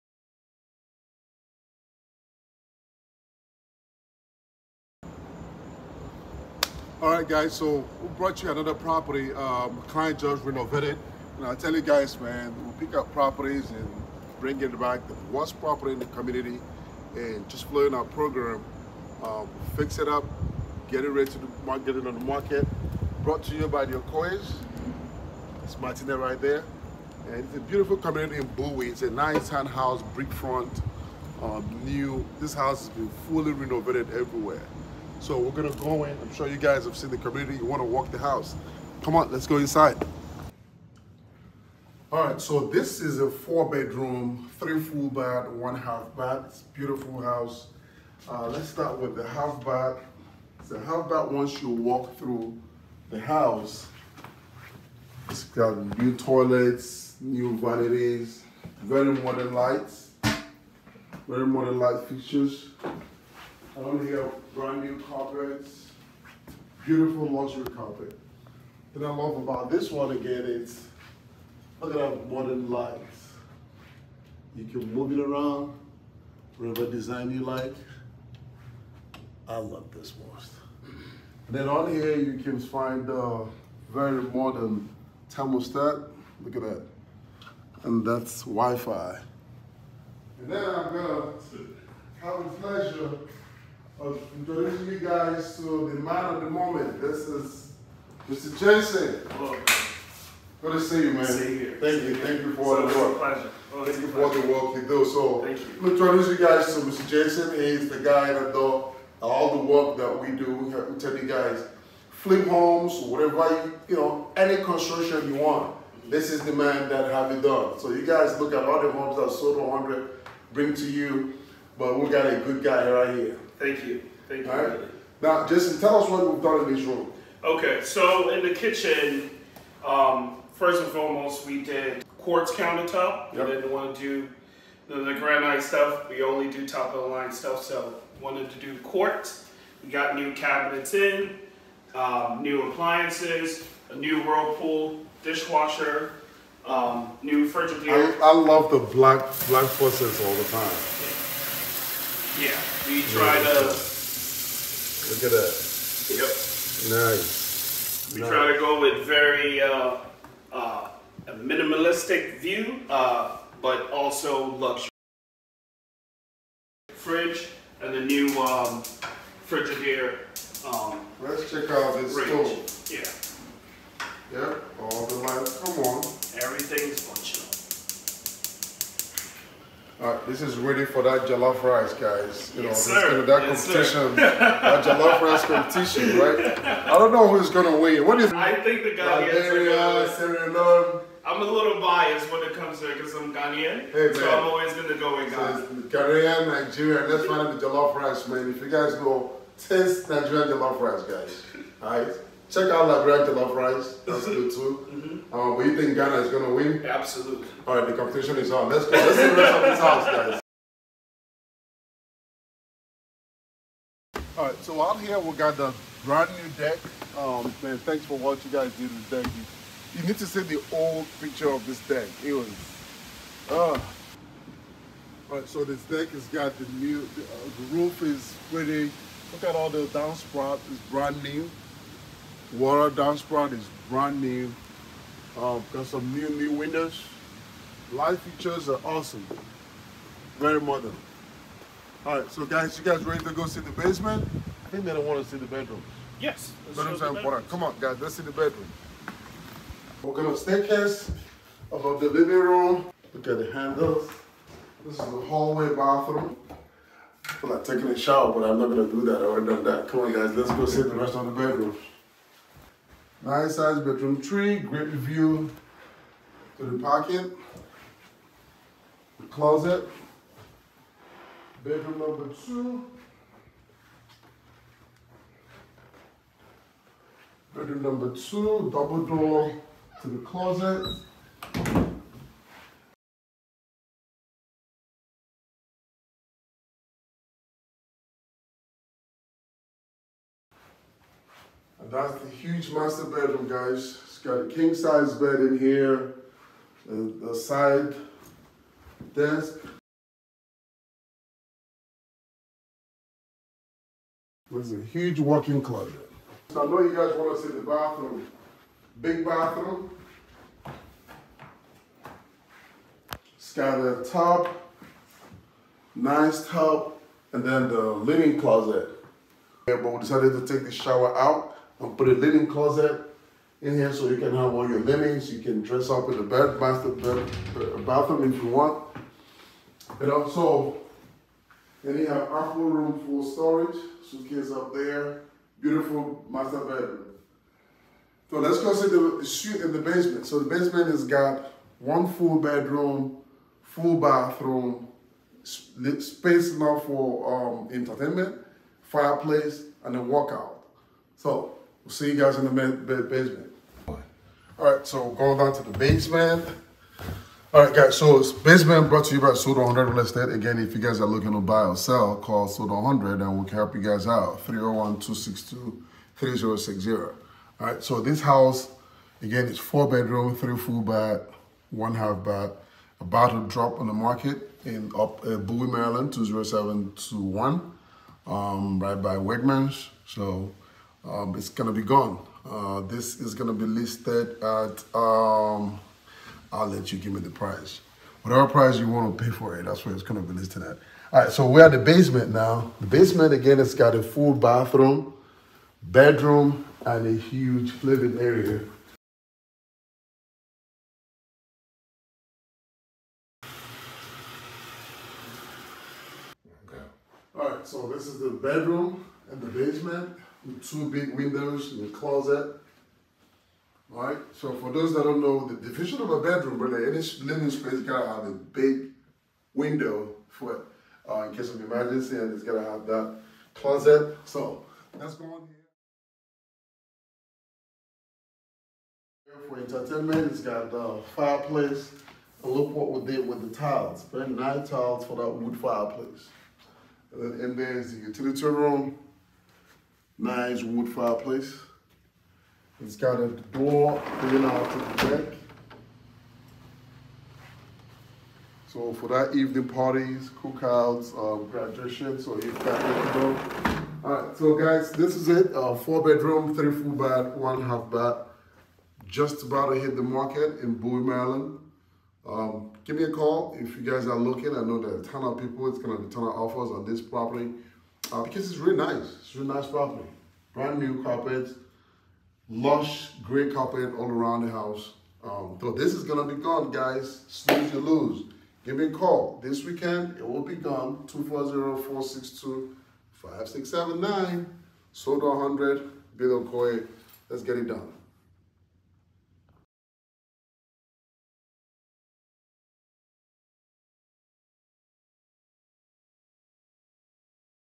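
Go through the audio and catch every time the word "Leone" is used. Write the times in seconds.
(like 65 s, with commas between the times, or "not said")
190 s.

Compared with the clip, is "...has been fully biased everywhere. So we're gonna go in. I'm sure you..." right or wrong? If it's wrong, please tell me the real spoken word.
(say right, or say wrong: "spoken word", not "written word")
wrong: "renovated", not "biased".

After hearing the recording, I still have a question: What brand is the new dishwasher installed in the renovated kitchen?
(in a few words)
Whirlpool.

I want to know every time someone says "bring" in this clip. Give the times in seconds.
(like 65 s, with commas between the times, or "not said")
14 s, 120 s.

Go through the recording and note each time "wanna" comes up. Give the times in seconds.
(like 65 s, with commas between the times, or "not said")
37 s, 388 s.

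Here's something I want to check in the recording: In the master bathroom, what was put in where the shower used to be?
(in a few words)
A linen closet.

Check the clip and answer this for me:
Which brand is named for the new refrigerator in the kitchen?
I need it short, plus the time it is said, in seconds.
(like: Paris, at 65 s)
Frigidaire, at 169 s.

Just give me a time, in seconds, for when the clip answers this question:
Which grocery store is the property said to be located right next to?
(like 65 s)
379 s.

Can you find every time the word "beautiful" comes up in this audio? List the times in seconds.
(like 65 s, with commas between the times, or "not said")
27 s, 46 s, 66 s, 335 s.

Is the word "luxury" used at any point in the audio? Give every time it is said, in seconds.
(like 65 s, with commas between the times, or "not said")
67 s, 164 s.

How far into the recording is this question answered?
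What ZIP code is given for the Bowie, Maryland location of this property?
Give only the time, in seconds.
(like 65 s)
376 s.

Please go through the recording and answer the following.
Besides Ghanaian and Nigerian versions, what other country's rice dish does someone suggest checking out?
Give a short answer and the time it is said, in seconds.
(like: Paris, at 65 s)
Liberian, at 202 s.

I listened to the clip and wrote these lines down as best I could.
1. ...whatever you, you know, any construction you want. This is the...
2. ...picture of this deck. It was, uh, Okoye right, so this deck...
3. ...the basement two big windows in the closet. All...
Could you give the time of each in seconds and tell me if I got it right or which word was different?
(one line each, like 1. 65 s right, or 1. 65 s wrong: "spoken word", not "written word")
1. 113 s right
2. 221 s wrong: "All", not "Okoye"
3. 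409 s right.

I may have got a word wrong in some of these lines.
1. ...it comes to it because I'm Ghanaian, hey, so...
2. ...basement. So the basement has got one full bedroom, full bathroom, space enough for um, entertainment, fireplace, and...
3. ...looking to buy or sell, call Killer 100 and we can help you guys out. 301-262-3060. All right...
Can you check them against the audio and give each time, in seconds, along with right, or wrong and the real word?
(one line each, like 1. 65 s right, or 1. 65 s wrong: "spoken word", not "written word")
1. 192 s right
2. 339 s right
3. 361 s wrong: "Sold", not "Killer".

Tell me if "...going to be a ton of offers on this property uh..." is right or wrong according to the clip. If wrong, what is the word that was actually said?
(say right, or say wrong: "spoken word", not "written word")
right.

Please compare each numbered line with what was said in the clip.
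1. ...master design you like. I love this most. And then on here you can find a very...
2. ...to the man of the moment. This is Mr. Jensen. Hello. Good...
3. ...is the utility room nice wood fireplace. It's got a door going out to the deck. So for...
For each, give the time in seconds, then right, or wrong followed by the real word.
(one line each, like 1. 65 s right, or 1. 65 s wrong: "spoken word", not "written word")
1. 76 s wrong: "whatever", not "master"
2. 95 s right
3. 437 s right.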